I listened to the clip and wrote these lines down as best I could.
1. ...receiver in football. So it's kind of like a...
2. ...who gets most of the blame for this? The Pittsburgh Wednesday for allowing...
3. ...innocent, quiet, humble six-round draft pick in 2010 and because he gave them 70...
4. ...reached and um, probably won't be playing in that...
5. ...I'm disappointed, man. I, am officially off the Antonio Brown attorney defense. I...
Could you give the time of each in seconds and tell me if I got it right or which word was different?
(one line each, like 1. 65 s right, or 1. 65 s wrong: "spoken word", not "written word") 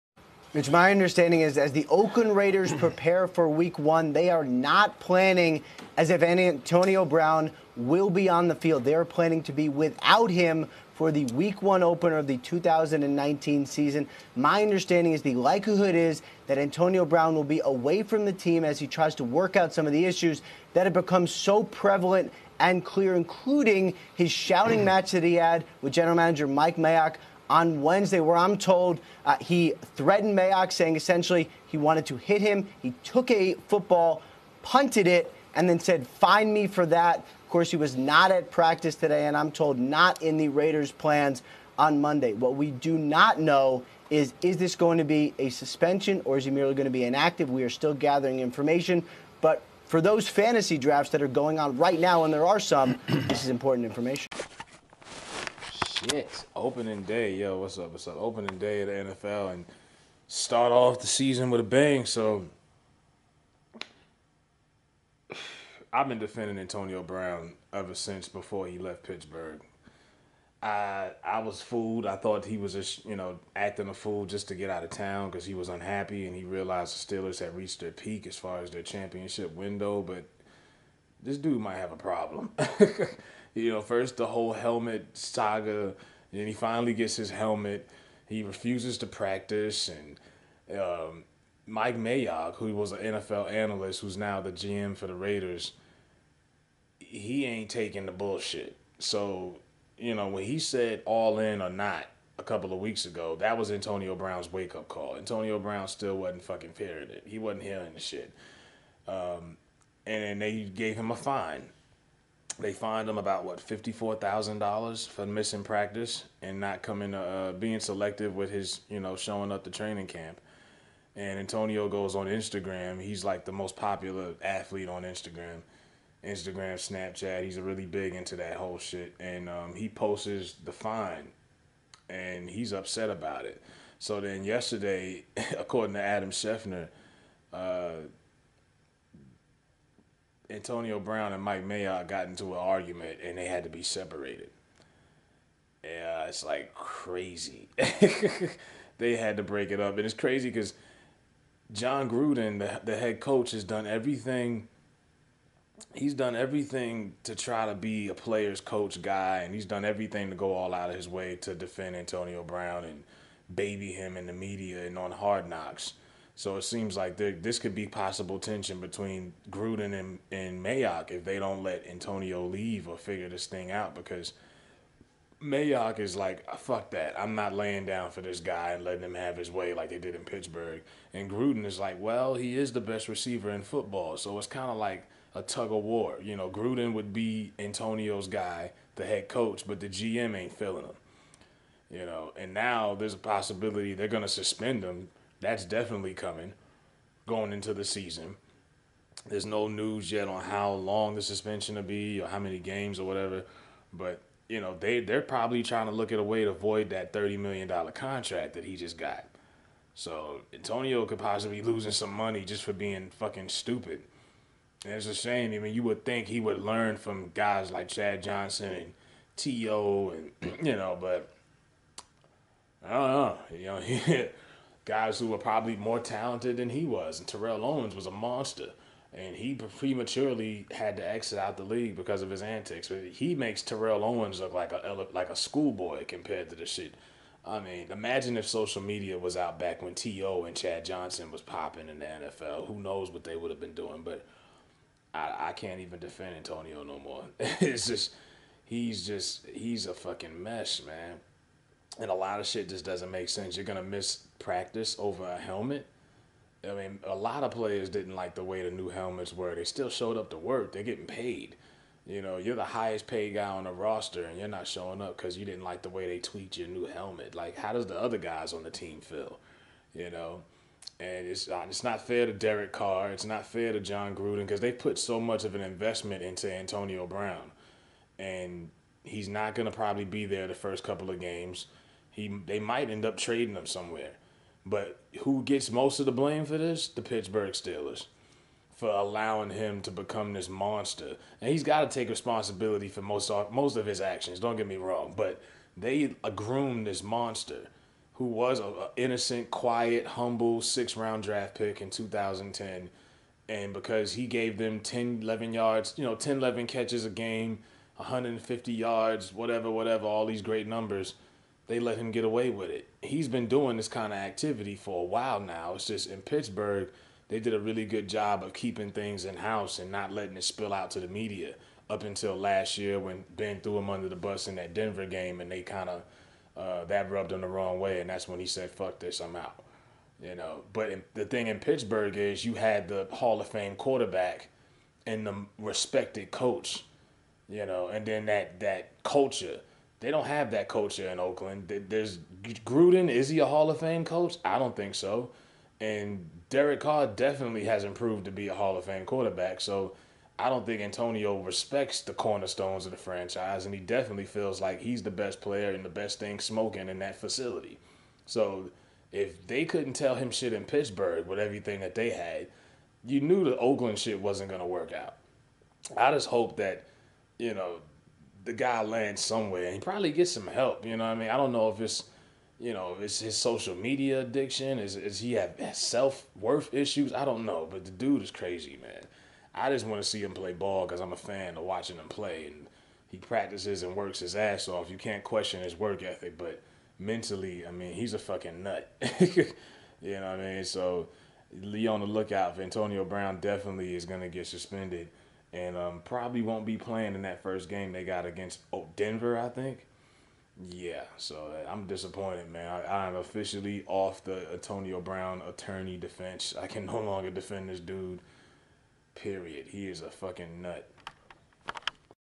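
1. 183 s right
2. 285 s wrong: "Steelers", not "Wednesday"
3. 298 s wrong: "10", not "70"
4. 394 s wrong: "suspended", not "reached"
5. 401 s right.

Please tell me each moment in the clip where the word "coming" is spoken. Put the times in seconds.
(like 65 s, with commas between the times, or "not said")
116 s, 196 s.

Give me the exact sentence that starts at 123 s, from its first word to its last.
He's like the most popular athlete on Instagram, Instagram, Snapchat.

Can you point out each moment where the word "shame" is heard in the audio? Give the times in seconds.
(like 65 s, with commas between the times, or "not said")
215 s.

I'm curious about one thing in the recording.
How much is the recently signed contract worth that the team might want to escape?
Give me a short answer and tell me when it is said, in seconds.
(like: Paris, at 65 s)
$30 million, at 207 s.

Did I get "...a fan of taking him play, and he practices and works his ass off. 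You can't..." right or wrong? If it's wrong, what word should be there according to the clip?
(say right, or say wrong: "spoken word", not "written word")
wrong: "watching", not "taking".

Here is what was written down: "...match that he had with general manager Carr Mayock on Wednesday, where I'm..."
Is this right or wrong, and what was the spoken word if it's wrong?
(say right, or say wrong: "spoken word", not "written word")
wrong: "Mike", not "Carr".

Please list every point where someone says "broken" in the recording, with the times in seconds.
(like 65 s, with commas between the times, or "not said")
not said.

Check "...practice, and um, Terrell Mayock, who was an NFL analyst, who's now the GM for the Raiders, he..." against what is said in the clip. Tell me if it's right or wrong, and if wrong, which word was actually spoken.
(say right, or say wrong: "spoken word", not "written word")
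wrong: "Mike", not "Terrell".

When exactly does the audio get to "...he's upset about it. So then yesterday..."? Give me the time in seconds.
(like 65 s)
132 s.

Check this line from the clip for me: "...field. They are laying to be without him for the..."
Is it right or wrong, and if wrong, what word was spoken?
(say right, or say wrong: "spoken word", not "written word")
wrong: "planning", not "laying".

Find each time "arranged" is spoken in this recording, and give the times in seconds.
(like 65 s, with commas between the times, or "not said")
not said.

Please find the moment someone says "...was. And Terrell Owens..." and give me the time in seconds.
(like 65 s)
226 s.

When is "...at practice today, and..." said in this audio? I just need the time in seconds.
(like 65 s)
38 s.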